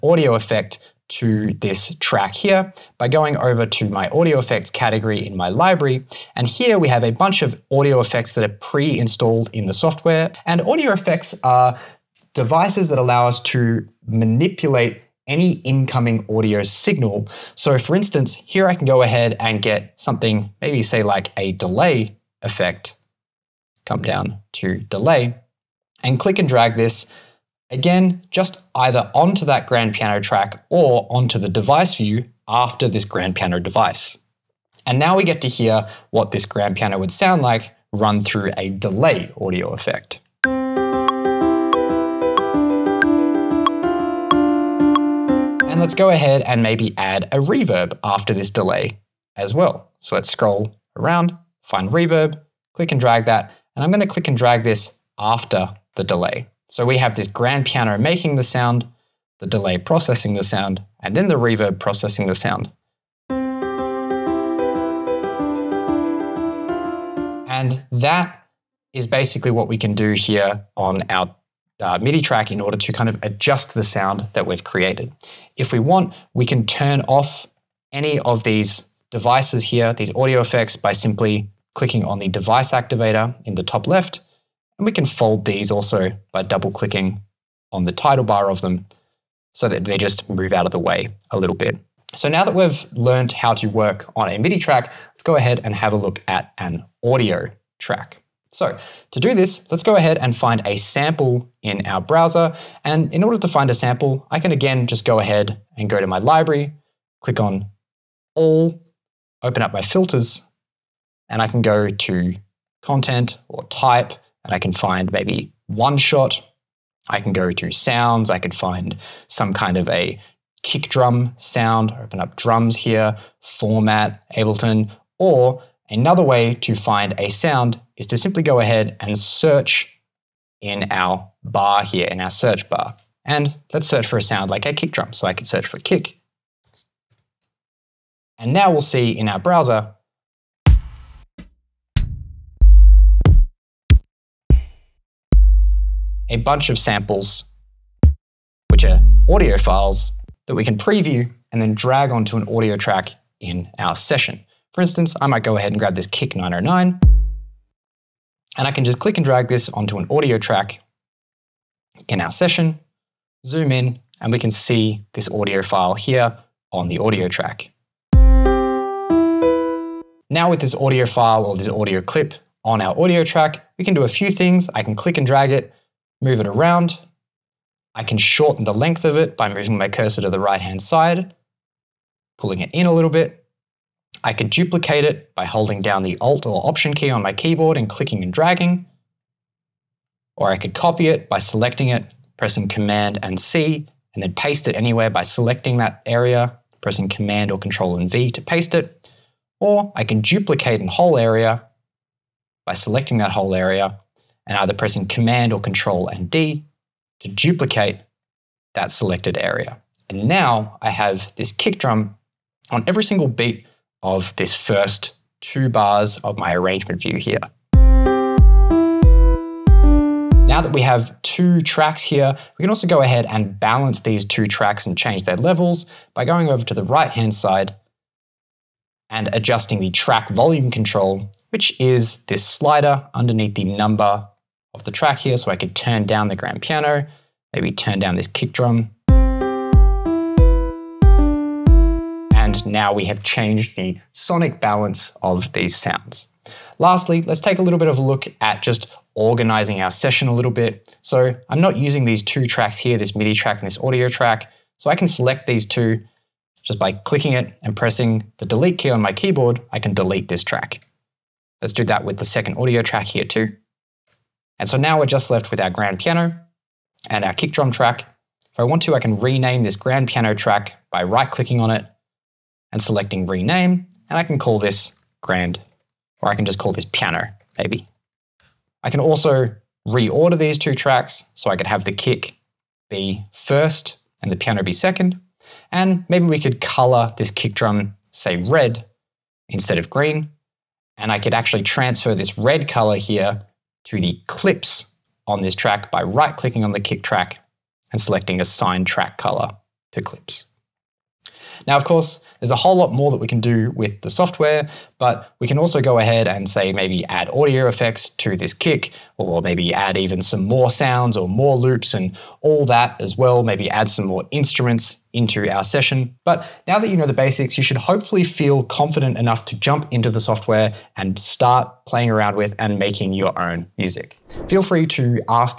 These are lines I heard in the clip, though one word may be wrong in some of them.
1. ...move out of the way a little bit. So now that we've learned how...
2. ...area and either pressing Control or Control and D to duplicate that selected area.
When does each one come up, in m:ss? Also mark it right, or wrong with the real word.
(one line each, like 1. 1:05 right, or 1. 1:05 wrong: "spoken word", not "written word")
1. 1:30 right
2. 3:23 wrong: "Command", not "Control".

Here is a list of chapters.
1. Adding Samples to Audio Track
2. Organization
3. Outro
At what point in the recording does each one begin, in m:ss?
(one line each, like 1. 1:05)
1. 1:45
2. 4:25
3. 5:15.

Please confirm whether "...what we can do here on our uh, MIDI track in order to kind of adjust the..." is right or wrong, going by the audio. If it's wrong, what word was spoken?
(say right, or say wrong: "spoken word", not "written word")
right.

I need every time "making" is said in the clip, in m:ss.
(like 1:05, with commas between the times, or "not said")
0:57, 5:22.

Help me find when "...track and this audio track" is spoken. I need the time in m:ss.
4:13.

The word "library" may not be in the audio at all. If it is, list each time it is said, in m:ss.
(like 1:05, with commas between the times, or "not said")
0:05, 1:46.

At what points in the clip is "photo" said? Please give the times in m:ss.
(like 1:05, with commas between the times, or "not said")
not said.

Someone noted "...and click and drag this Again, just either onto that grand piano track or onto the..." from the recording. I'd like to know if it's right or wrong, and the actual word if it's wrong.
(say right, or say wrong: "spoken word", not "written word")
right.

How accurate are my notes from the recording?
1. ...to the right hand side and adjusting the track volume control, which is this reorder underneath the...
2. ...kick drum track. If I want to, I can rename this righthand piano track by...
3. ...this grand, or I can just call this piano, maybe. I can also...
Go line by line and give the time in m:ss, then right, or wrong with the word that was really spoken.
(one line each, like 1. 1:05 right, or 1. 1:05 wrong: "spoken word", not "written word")
1. 3:46 wrong: "slider", not "reorder"
2. 4:27 wrong: "grand", not "righthand"
3. 4:34 right.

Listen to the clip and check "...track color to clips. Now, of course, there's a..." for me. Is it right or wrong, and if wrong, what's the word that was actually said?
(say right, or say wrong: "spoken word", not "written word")
right.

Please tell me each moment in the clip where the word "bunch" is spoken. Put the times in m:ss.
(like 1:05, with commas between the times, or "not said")
0:07, 2:26.